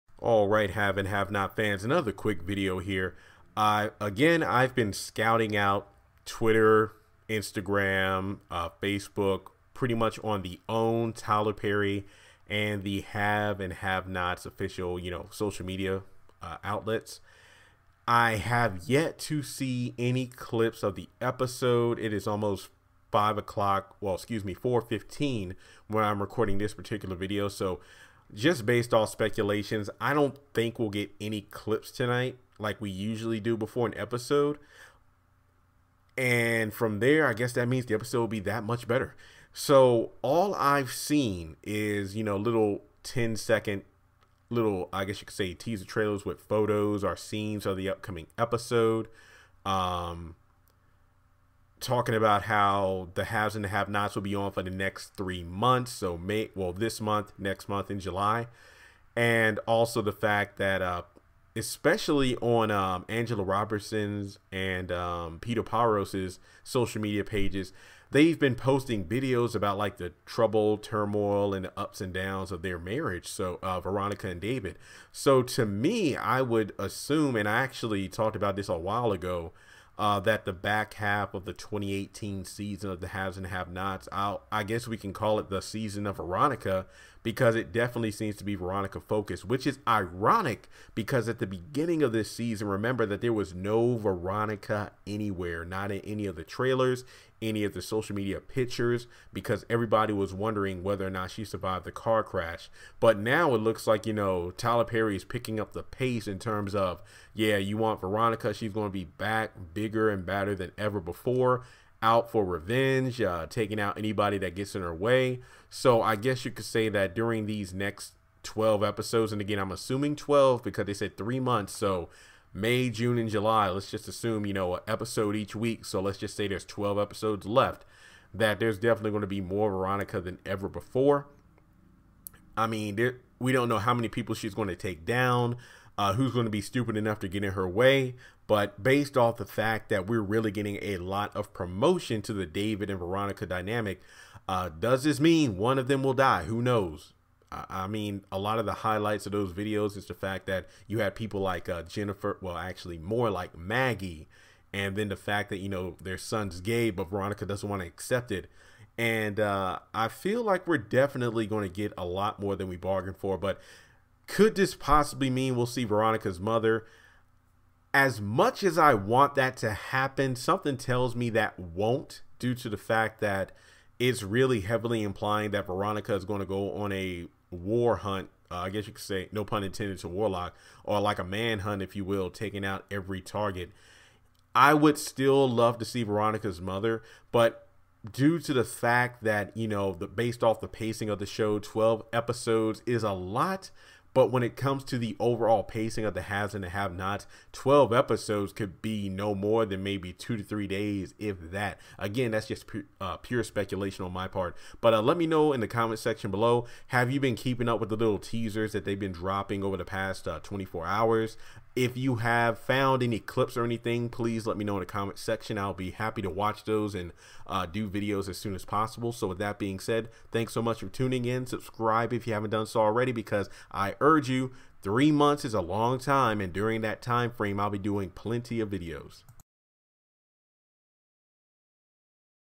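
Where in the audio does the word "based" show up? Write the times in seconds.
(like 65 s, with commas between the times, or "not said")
28 s, 138 s, 190 s.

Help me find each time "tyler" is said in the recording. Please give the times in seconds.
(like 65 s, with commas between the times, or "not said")
11 s, 104 s.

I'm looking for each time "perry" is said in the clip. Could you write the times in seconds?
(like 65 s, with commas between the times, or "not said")
11 s, 104 s.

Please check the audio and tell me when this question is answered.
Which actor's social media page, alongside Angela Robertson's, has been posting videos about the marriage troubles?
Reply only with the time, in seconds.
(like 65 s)
65 s.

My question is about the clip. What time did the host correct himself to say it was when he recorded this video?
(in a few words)
4:15.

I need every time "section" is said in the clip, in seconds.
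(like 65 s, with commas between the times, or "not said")
205 s, 215 s.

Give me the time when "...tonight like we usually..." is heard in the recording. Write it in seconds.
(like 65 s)
31 s.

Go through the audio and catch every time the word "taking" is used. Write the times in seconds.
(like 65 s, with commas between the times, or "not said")
113 s, 182 s.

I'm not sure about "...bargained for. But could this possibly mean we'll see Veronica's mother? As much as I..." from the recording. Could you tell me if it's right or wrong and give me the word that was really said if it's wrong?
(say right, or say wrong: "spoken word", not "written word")
right.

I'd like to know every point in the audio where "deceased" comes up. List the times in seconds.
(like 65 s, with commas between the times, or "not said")
not said.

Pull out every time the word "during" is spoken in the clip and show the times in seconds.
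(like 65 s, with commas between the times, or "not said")
117 s, 226 s.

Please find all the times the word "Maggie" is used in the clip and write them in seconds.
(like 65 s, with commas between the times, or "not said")
153 s.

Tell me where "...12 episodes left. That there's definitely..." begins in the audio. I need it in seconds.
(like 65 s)
126 s.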